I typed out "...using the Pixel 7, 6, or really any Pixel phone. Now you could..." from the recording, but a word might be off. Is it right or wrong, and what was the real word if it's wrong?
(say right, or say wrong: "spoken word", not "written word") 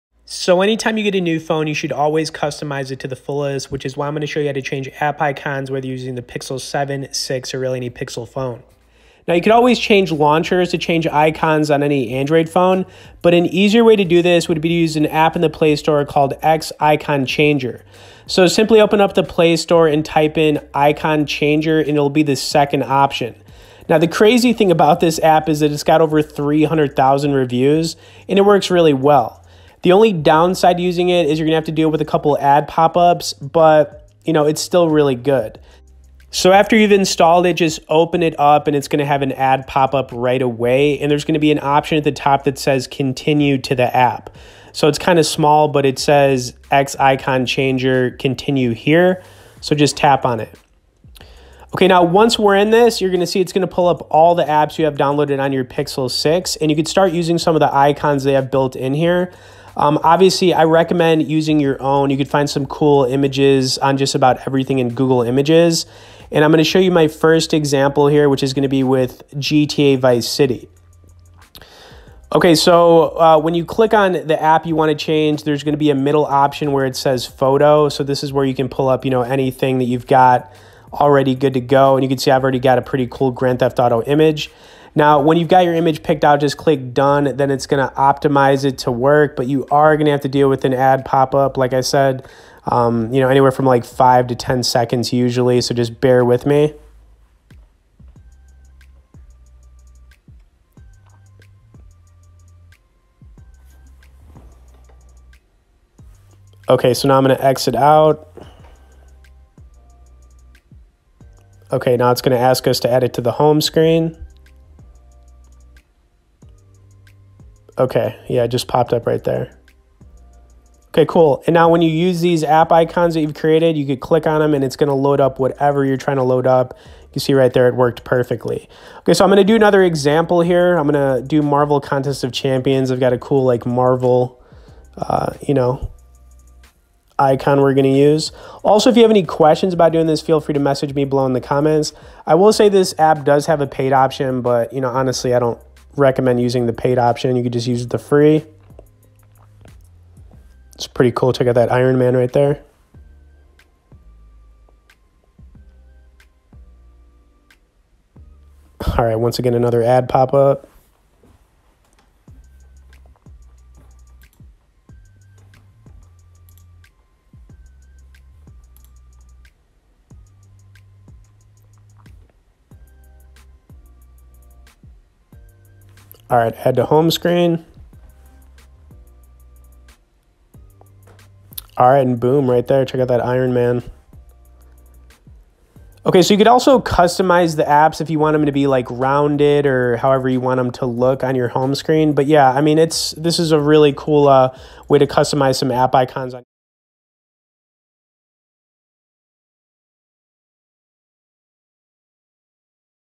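right.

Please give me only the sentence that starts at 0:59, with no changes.
Um, obviously, I recommend using your own.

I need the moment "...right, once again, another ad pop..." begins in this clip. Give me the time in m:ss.
2:39.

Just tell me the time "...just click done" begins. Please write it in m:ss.
1:26.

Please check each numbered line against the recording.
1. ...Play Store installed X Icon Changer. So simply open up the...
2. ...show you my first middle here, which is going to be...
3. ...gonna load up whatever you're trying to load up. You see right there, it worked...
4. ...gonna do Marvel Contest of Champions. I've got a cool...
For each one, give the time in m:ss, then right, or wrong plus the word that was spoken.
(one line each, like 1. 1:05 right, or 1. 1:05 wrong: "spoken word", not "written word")
1. 0:15 wrong: "called", not "installed"
2. 1:06 wrong: "example", not "middle"
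3. 2:04 right
4. 2:10 right.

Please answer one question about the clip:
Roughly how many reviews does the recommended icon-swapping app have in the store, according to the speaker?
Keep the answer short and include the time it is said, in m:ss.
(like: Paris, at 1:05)
over 300,000, at 0:25.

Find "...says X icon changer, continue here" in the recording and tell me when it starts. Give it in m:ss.
0:45.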